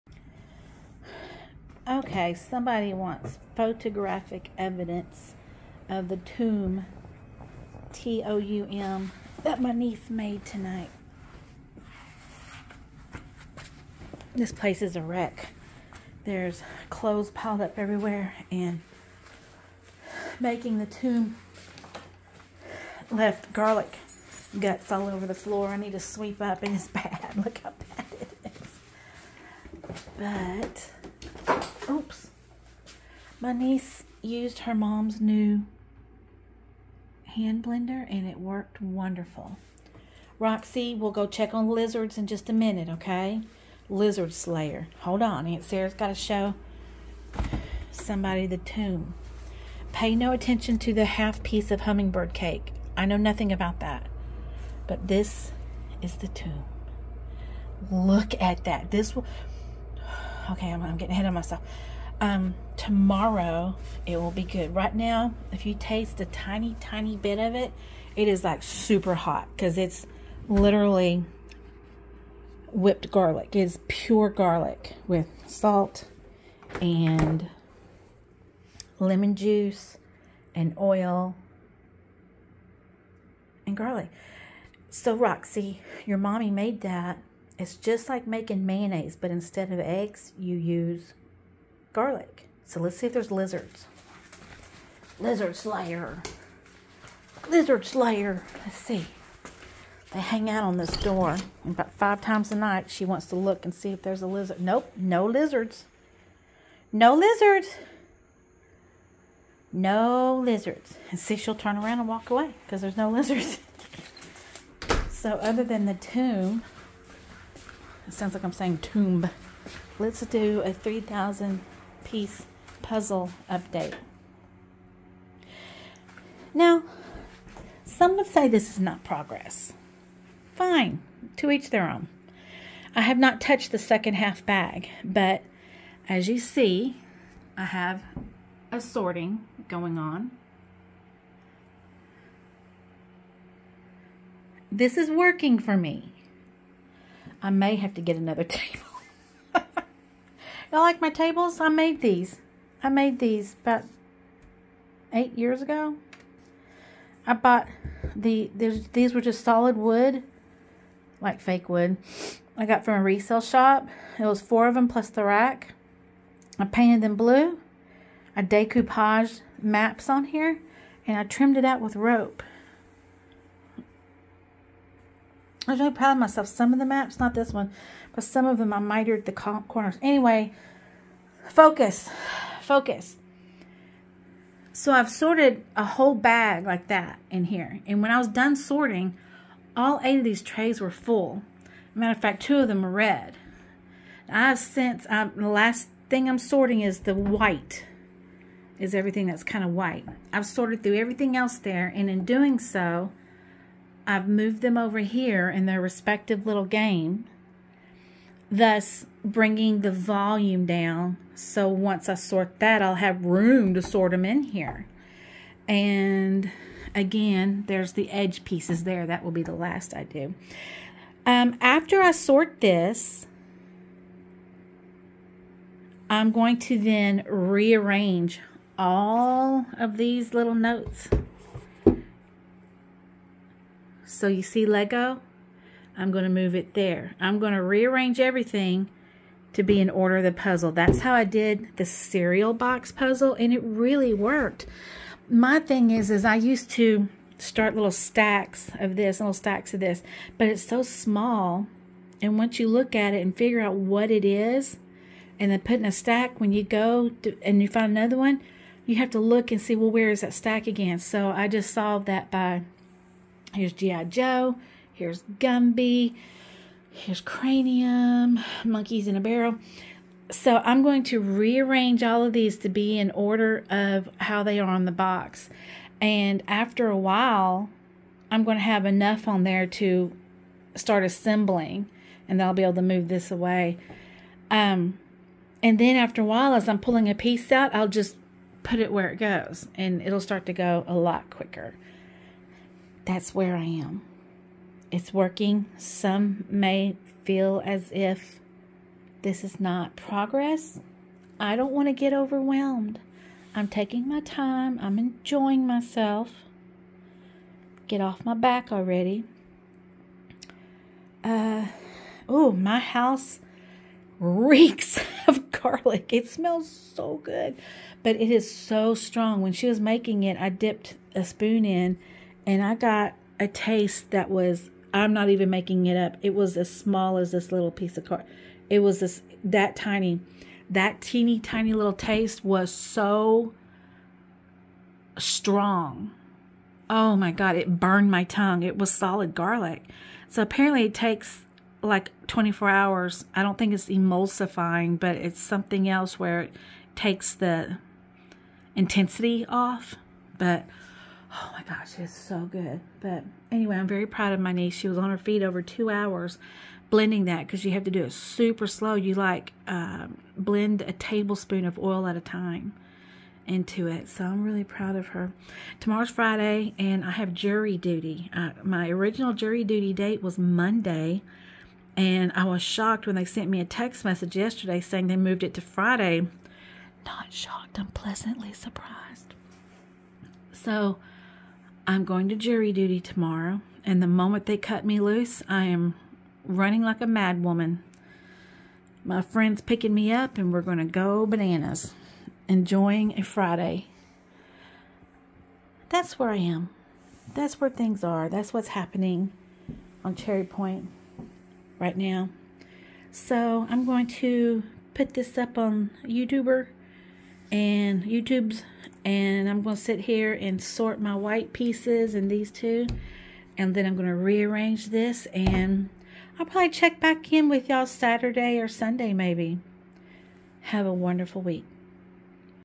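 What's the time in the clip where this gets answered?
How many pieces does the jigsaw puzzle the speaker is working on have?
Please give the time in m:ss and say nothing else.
2:00.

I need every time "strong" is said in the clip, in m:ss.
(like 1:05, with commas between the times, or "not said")
5:18, 5:35.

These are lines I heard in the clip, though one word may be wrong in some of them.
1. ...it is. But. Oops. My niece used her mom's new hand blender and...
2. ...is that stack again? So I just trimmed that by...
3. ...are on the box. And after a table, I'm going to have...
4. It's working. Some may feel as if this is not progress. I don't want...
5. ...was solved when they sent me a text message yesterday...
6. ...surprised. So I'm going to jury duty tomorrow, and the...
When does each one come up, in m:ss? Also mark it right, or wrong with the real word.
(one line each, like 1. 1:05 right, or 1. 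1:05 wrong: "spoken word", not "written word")
1. 0:28 right
2. 4:20 wrong: "solved", not "trimmed"
3. 4:34 wrong: "while", not "table"
4. 4:54 right
5. 6:12 wrong: "shocked", not "solved"
6. 6:18 right.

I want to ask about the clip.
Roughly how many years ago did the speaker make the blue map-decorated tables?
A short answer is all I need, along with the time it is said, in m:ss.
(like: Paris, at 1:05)
8, at 2:35.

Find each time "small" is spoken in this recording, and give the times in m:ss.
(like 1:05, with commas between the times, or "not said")
4:10, 5:26.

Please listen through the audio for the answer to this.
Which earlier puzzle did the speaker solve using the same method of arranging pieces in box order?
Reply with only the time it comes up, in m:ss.
4:01.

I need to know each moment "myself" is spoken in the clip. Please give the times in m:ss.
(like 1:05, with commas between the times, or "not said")
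1:01, 2:56, 5:05.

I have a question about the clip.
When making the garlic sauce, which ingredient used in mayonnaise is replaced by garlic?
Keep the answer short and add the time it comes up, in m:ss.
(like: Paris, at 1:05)
eggs, at 1:29.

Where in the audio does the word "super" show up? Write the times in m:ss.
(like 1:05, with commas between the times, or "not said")
1:08, 5:58.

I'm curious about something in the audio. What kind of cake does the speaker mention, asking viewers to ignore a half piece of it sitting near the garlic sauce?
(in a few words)
hummingbird cake.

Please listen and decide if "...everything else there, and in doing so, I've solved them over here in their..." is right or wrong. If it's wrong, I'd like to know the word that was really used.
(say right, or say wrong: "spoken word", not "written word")
wrong: "moved", not "solved".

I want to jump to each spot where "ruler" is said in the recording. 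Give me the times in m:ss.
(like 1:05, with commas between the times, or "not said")
not said.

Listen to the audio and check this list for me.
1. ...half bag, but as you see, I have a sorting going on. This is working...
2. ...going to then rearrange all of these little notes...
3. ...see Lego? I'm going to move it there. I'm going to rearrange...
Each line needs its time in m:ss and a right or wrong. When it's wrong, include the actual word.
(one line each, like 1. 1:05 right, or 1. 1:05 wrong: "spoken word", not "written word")
1. 2:14 right
2. 3:46 right
3. 3:54 right.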